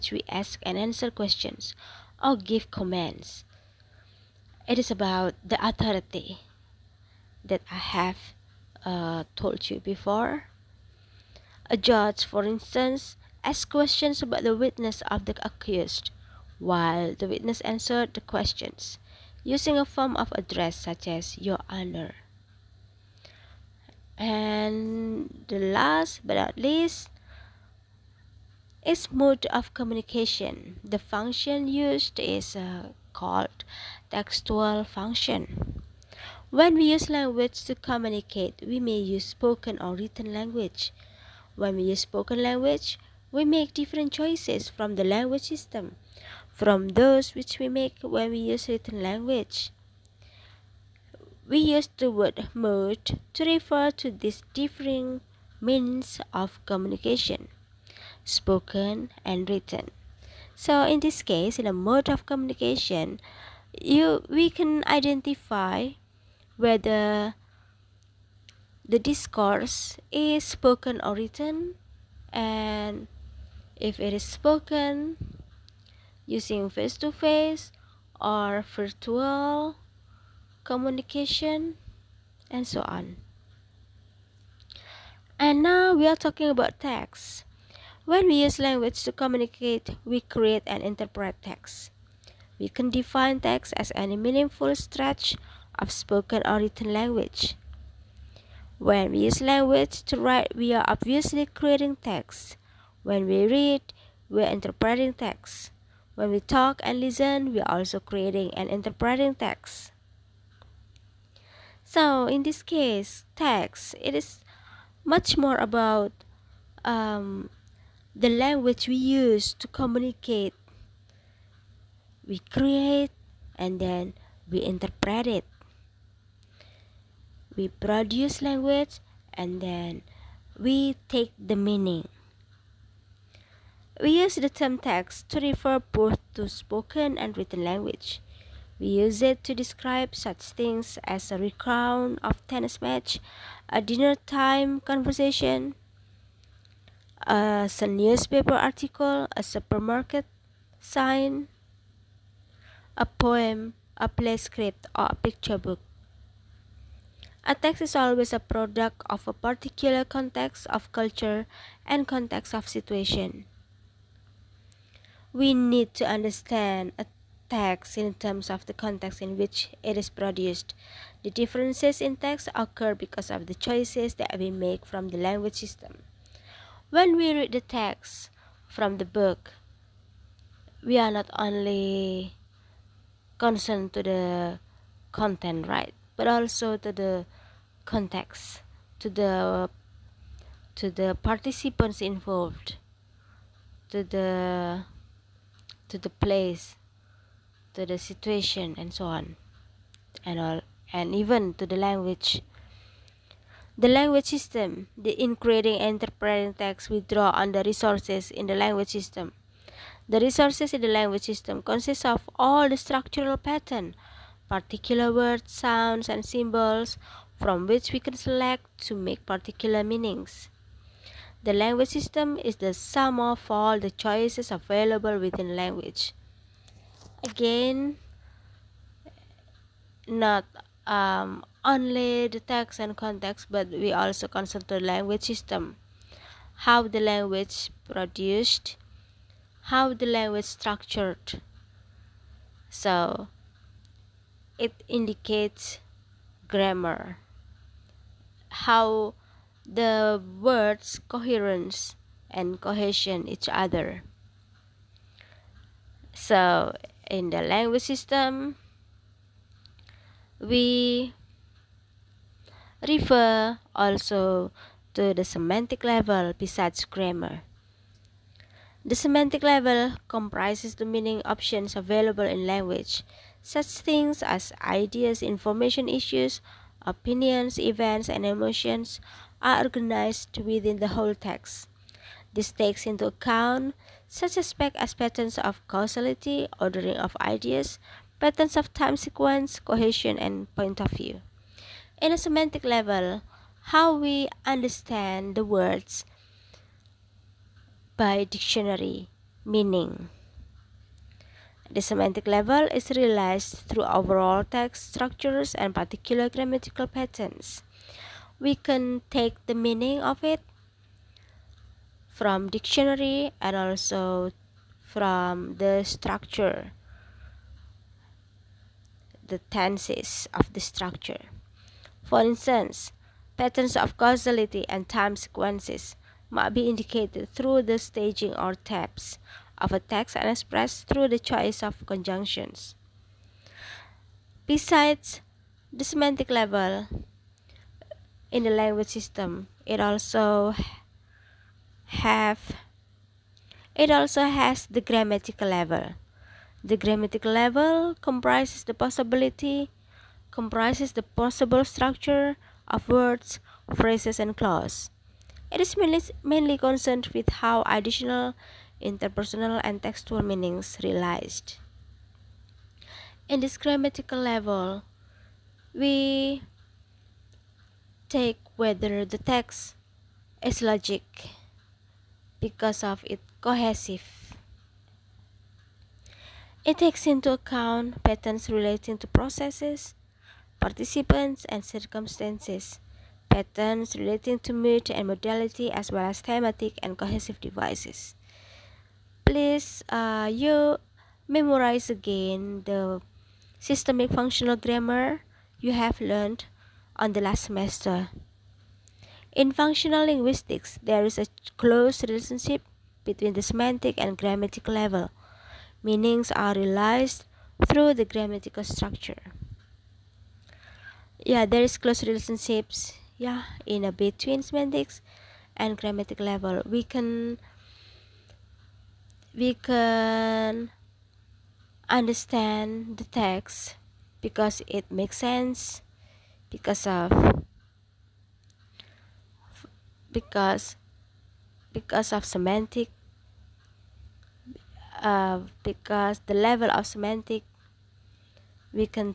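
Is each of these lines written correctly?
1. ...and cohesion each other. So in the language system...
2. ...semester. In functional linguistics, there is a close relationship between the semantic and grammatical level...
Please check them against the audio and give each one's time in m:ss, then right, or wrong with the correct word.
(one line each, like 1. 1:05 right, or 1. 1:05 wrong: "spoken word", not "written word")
1. 4:12 right
2. 6:37 right.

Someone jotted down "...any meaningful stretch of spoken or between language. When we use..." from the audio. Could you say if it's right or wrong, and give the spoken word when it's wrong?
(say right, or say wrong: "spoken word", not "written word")
wrong: "written", not "between".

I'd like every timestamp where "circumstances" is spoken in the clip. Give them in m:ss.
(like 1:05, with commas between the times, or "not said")
6:21.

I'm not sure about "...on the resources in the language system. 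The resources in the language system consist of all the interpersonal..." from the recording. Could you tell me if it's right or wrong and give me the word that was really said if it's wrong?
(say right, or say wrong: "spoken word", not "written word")
wrong: "structural", not "interpersonal".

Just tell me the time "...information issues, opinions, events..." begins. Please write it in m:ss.
4:35.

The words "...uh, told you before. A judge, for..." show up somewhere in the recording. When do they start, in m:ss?
0:08.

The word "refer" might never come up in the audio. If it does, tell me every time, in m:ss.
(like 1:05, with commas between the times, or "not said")
0:53, 2:15, 4:22.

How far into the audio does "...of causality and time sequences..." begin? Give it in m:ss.
5:23.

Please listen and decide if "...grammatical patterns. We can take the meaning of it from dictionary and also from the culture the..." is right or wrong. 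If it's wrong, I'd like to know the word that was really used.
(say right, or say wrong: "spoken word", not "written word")
wrong: "structure", not "culture".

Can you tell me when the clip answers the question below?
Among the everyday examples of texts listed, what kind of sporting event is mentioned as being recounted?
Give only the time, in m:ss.
2:22.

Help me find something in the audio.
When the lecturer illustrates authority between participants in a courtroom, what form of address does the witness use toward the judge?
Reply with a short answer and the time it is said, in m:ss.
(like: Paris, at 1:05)
Your Honor, at 0:21.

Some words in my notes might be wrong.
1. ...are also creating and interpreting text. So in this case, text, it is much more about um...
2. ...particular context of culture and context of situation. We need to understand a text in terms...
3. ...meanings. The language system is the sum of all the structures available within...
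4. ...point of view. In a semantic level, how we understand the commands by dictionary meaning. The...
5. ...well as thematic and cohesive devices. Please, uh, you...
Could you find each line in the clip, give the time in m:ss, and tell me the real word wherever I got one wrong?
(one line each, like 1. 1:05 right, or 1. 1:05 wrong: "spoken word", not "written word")
1. 1:47 right
2. 2:39 right
3. 3:39 wrong: "choices", not "structures"
4. 4:50 wrong: "words", not "commands"
5. 6:25 right.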